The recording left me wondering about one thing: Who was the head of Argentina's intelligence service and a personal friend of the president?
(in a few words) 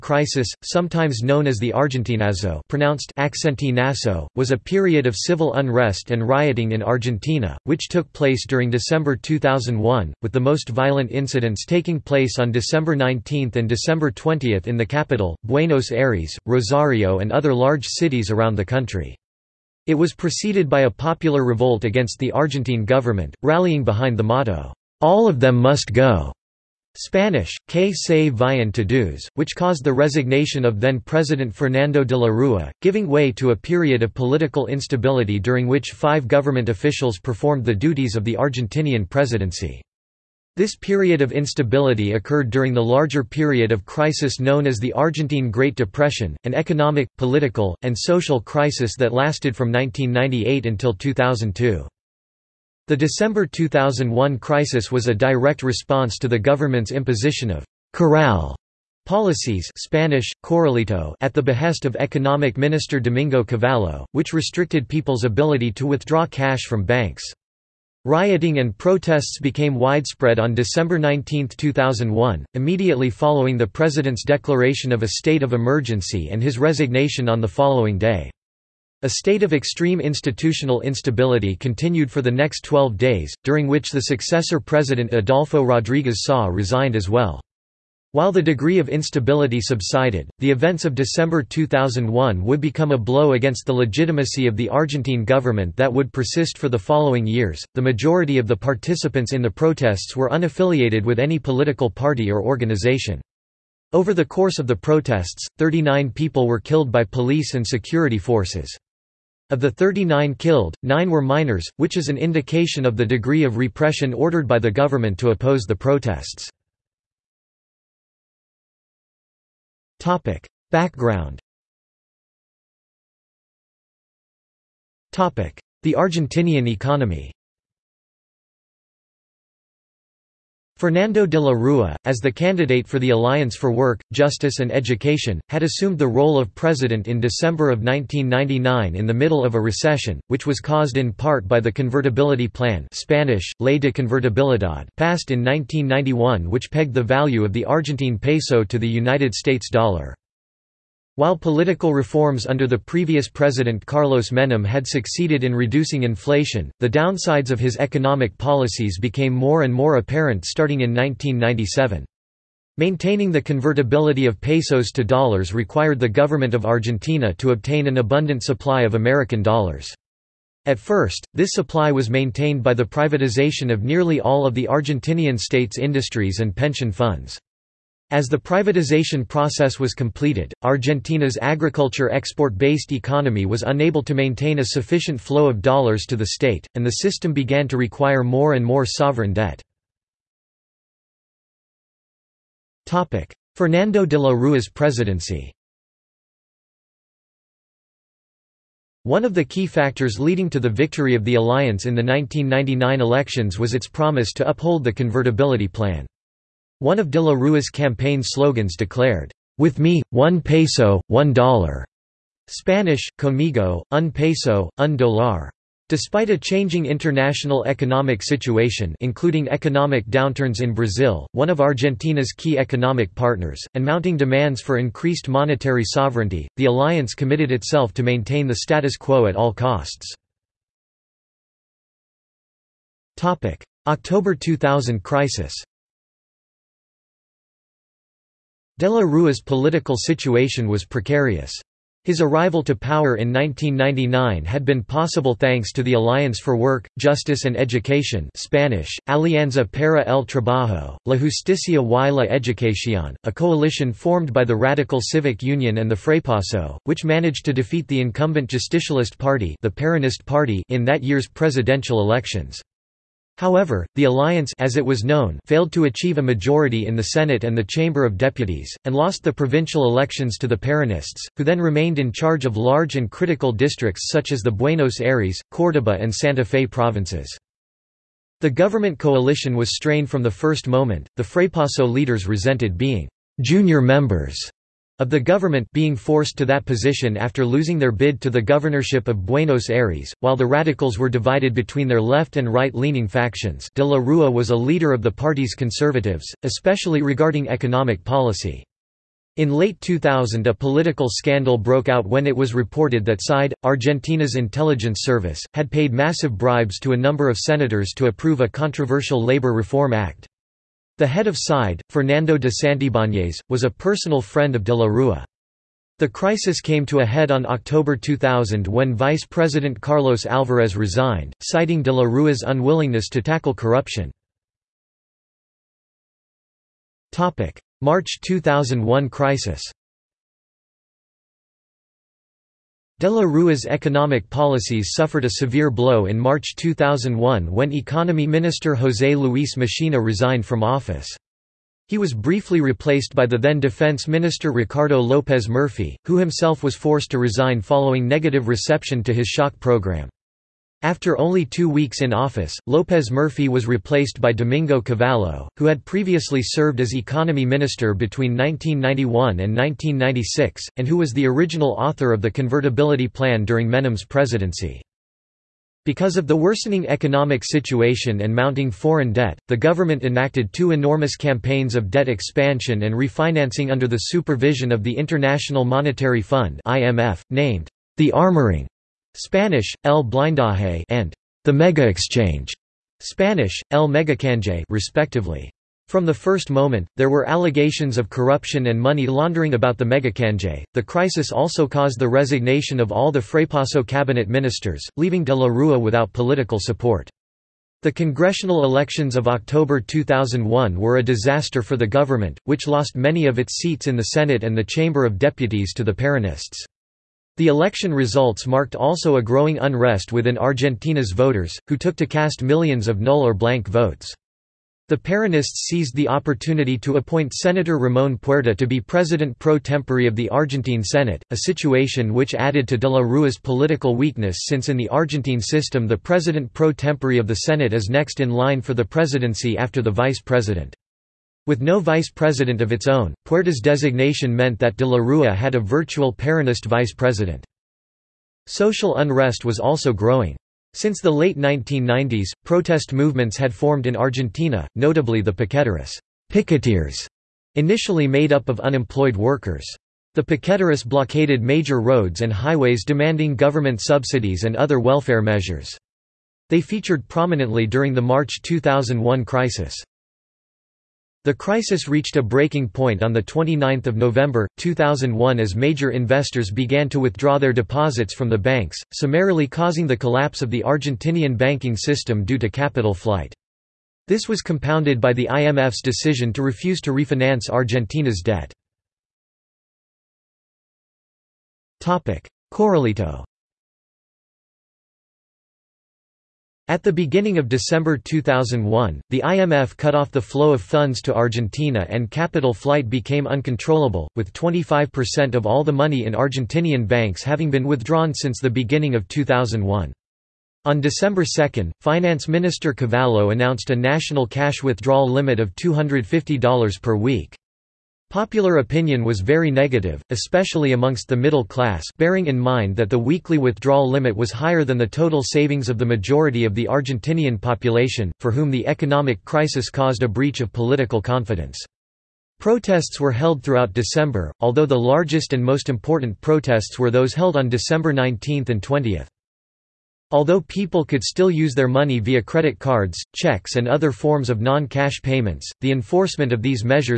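Fernando de Santibañez.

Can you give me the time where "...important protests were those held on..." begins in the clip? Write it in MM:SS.
08:45.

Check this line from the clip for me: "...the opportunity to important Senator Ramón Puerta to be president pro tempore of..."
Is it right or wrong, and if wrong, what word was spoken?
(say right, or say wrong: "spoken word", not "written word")
wrong: "appoint", not "important".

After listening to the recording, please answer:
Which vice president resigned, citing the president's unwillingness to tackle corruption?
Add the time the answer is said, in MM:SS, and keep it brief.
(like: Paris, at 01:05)
Carlos Alvarez, at 05:19.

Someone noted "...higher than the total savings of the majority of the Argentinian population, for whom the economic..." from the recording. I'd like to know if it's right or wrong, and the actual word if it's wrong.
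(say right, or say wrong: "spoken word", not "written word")
right.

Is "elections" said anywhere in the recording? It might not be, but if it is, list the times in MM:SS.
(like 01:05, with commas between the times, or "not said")
03:23, 04:22, 04:29, 06:38, 06:47.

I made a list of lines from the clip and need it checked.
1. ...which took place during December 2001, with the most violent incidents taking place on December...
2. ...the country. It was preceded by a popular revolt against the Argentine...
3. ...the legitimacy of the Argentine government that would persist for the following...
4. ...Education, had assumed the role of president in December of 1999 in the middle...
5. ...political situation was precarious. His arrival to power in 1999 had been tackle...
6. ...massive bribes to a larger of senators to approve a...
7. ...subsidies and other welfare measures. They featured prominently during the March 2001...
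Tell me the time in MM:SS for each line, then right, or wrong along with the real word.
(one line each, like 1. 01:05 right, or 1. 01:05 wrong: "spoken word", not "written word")
1. 00:07 right
2. 00:18 right
3. 01:33 right
4. 02:14 right
5. 03:59 wrong: "possible", not "tackle"
6. 05:05 wrong: "number", not "larger"
7. 07:33 right.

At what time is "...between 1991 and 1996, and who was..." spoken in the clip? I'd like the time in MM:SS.
05:57.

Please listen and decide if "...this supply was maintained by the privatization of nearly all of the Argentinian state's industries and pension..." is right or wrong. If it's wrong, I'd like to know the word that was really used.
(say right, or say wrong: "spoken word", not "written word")
right.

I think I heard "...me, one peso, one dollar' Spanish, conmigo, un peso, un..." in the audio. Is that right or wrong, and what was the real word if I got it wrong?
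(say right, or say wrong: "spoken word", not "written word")
right.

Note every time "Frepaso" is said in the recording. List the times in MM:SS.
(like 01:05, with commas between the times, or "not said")
04:15, 04:41, 06:33.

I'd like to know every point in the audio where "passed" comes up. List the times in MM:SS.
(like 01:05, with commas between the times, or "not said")
02:24.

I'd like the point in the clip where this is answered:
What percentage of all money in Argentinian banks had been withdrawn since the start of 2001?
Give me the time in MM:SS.
08:14.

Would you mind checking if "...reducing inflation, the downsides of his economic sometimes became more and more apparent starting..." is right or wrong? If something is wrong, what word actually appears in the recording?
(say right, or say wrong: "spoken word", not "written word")
wrong: "policies", not "sometimes".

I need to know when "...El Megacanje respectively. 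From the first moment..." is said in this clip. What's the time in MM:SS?
06:23.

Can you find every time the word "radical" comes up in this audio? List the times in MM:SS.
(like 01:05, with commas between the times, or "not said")
04:14, 04:50.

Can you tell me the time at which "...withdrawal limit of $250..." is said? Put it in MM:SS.
08:24.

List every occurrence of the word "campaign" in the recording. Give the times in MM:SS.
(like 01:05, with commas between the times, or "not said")
03:27, 06:11.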